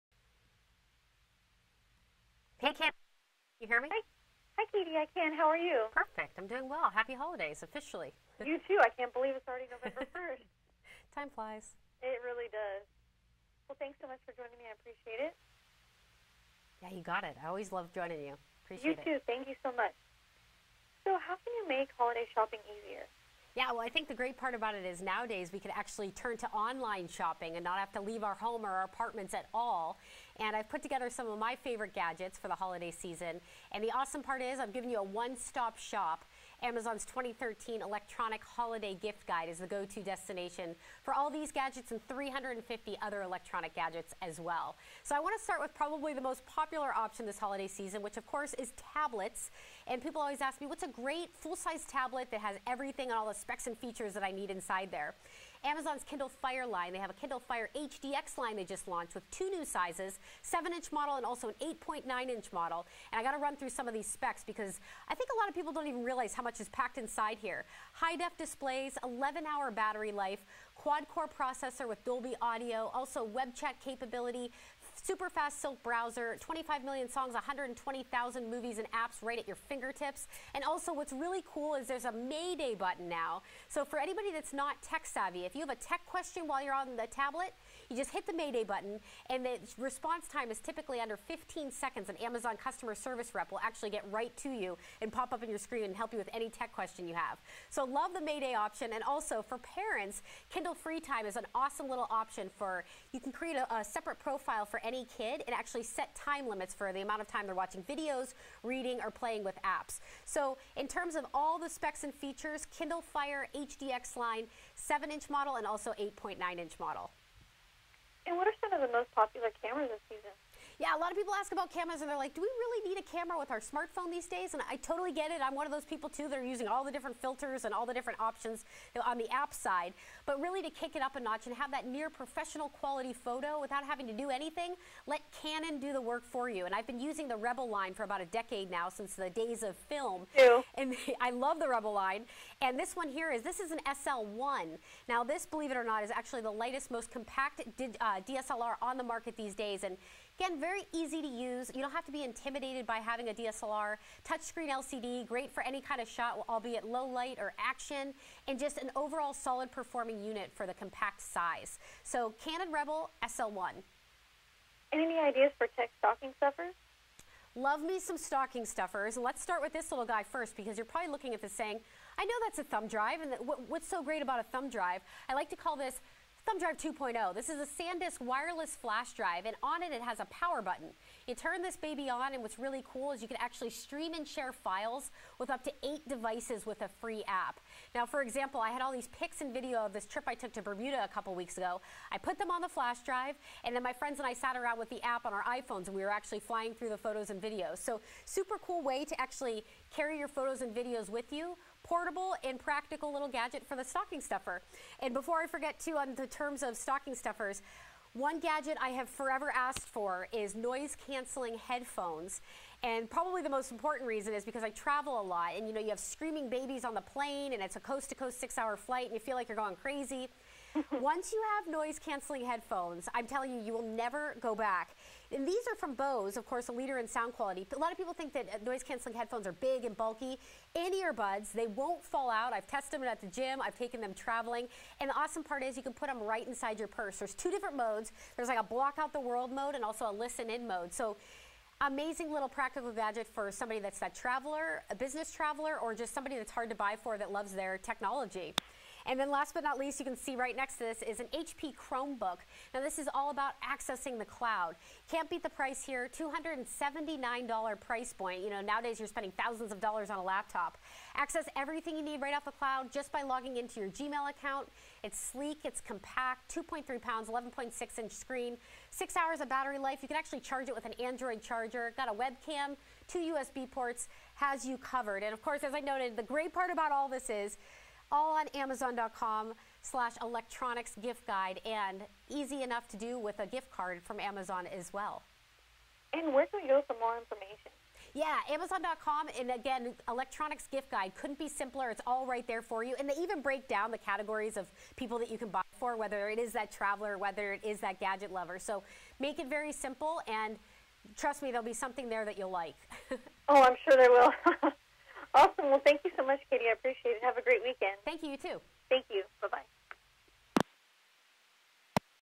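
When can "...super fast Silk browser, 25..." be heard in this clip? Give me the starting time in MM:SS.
01:14.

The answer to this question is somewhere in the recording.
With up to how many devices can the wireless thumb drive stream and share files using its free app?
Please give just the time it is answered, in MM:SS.
03:05.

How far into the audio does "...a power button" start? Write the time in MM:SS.
03:00.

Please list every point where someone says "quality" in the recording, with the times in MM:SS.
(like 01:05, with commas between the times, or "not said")
02:12, 03:47.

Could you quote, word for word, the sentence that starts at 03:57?
There's two different modes there's like a block out the world mode and also a listen in mode.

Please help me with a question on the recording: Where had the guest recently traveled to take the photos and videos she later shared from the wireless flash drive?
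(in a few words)
Bermuda.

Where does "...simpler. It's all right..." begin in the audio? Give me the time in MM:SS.
04:51.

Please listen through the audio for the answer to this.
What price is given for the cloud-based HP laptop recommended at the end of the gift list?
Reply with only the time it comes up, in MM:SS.
04:16.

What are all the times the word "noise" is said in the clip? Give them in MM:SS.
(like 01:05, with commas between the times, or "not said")
03:30, 03:41, 03:48.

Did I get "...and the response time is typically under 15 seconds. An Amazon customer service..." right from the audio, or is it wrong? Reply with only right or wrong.
right.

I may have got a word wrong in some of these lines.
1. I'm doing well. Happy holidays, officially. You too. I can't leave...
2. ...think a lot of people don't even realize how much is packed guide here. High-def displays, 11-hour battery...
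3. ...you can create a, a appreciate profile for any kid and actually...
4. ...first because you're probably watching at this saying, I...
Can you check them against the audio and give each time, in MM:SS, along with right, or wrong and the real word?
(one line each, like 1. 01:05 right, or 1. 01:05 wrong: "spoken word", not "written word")
1. 00:06 wrong: "believe", not "leave"
2. 01:05 wrong: "inside", not "guide"
3. 01:43 wrong: "separate", not "appreciate"
4. 02:50 wrong: "looking", not "watching".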